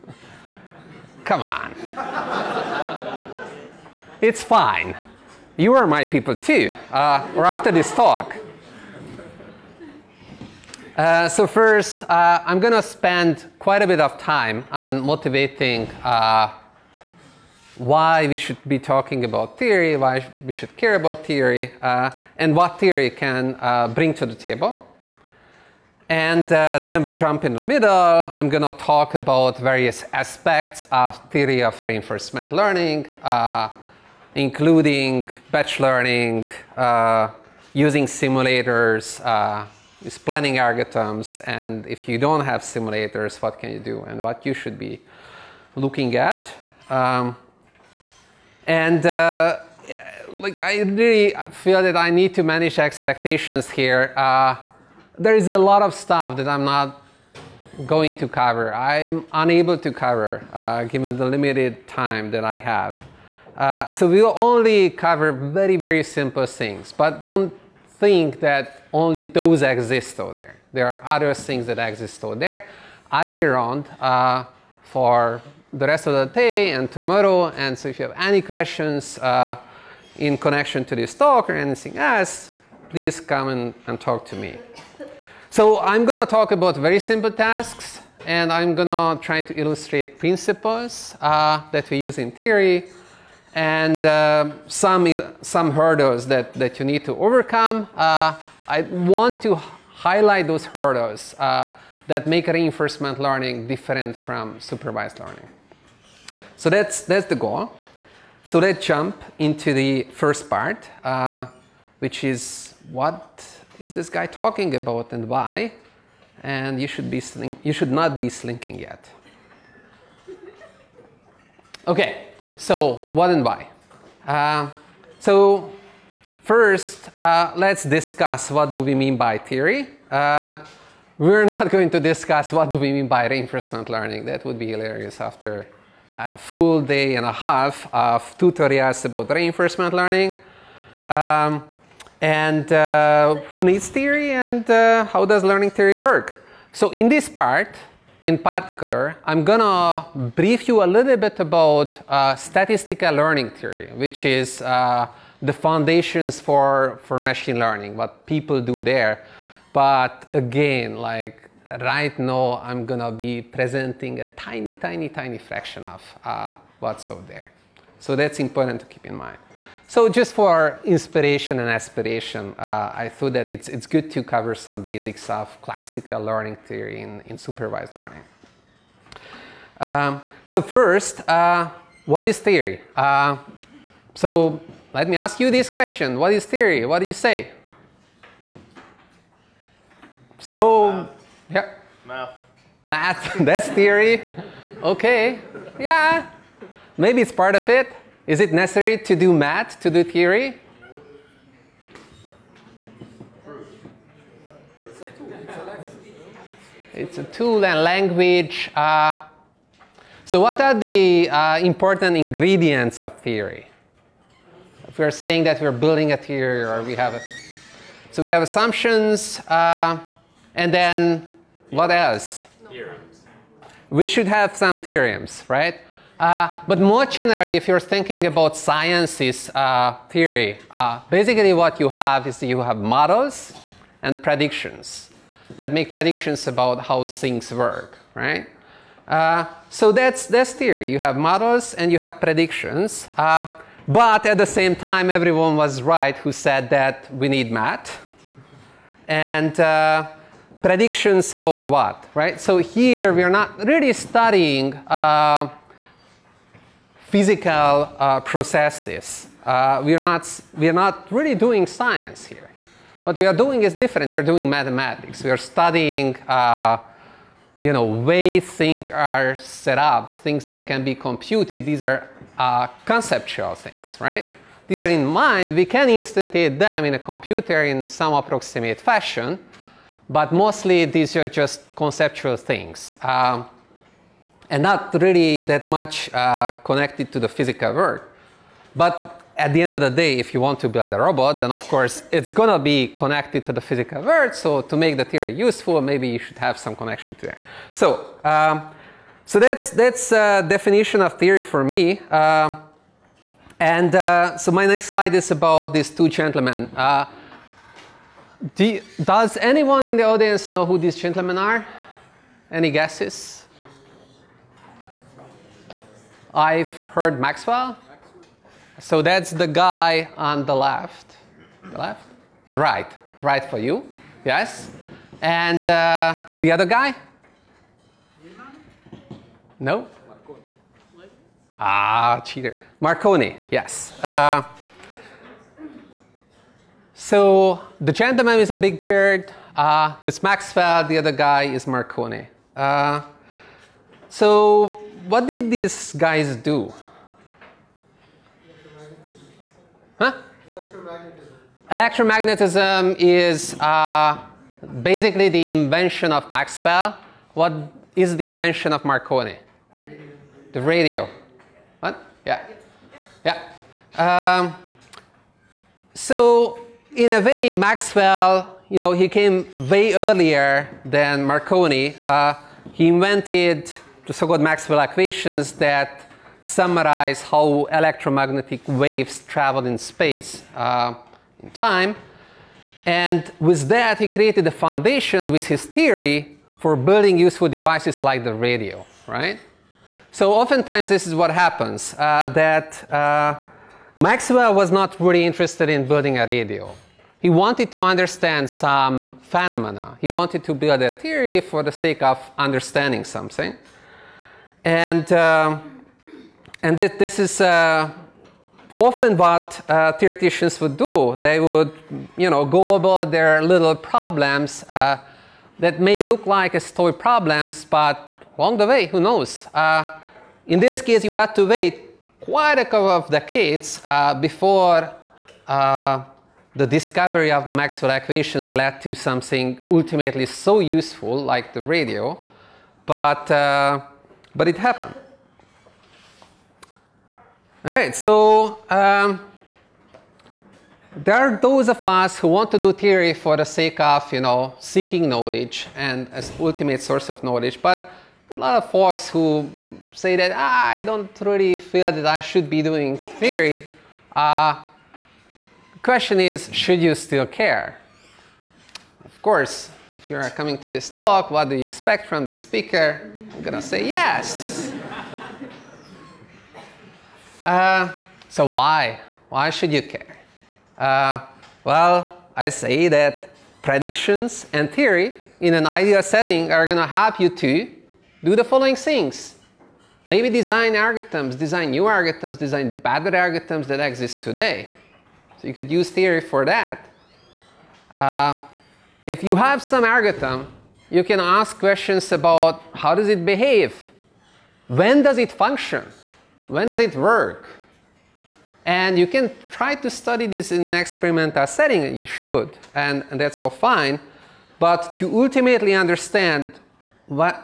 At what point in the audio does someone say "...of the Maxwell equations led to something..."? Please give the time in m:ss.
7:07.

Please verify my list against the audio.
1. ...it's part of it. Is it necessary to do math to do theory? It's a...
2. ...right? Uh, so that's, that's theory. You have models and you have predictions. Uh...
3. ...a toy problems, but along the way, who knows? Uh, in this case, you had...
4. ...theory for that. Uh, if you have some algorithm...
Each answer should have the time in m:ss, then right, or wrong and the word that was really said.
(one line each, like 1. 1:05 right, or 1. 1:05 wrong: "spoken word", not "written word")
1. 3:17 right
2. 3:58 right
3. 6:56 right
4. 8:05 right.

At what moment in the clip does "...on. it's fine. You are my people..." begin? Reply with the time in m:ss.
0:01.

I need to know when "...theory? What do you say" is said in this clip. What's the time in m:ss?
3:06.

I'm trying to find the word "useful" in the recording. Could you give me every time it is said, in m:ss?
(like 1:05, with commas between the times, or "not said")
4:55, 6:27, 7:10.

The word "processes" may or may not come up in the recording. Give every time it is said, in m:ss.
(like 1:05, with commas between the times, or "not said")
4:18.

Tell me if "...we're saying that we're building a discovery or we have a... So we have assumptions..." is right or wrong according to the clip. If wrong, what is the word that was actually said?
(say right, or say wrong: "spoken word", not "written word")
wrong: "theory", not "discovery".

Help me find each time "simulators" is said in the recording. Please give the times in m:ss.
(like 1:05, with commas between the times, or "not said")
0:38, 0:42.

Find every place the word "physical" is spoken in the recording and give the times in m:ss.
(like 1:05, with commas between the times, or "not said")
4:17, 4:47, 4:53.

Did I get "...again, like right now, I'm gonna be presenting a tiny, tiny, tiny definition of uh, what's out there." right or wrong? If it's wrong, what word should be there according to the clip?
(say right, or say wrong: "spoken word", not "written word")
wrong: "fraction", not "definition".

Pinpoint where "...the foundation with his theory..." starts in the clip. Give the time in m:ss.
6:24.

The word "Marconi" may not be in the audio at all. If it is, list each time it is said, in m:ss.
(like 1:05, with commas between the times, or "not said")
5:32, 5:41, 5:58, 6:11.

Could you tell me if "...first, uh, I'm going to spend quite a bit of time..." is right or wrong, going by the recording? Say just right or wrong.
right.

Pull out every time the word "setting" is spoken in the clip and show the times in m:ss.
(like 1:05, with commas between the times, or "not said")
7:56, 8:21.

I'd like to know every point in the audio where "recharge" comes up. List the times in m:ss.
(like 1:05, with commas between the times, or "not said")
not said.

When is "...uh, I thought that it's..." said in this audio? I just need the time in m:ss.
2:52.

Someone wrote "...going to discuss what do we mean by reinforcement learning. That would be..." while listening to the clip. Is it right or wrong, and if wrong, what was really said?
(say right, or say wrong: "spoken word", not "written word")
right.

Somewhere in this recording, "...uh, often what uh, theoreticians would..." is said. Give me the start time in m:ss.
6:47.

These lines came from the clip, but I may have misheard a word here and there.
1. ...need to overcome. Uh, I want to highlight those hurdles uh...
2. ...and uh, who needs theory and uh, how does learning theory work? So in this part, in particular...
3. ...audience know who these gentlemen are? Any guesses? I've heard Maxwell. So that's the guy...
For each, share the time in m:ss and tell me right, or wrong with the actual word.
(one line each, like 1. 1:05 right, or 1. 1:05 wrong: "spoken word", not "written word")
1. 1:36 right
2. 2:22 right
3. 5:10 right.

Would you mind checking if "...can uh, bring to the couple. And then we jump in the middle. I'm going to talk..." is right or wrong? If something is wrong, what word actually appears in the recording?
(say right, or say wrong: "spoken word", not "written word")
wrong: "table", not "couple".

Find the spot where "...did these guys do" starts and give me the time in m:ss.
5:45.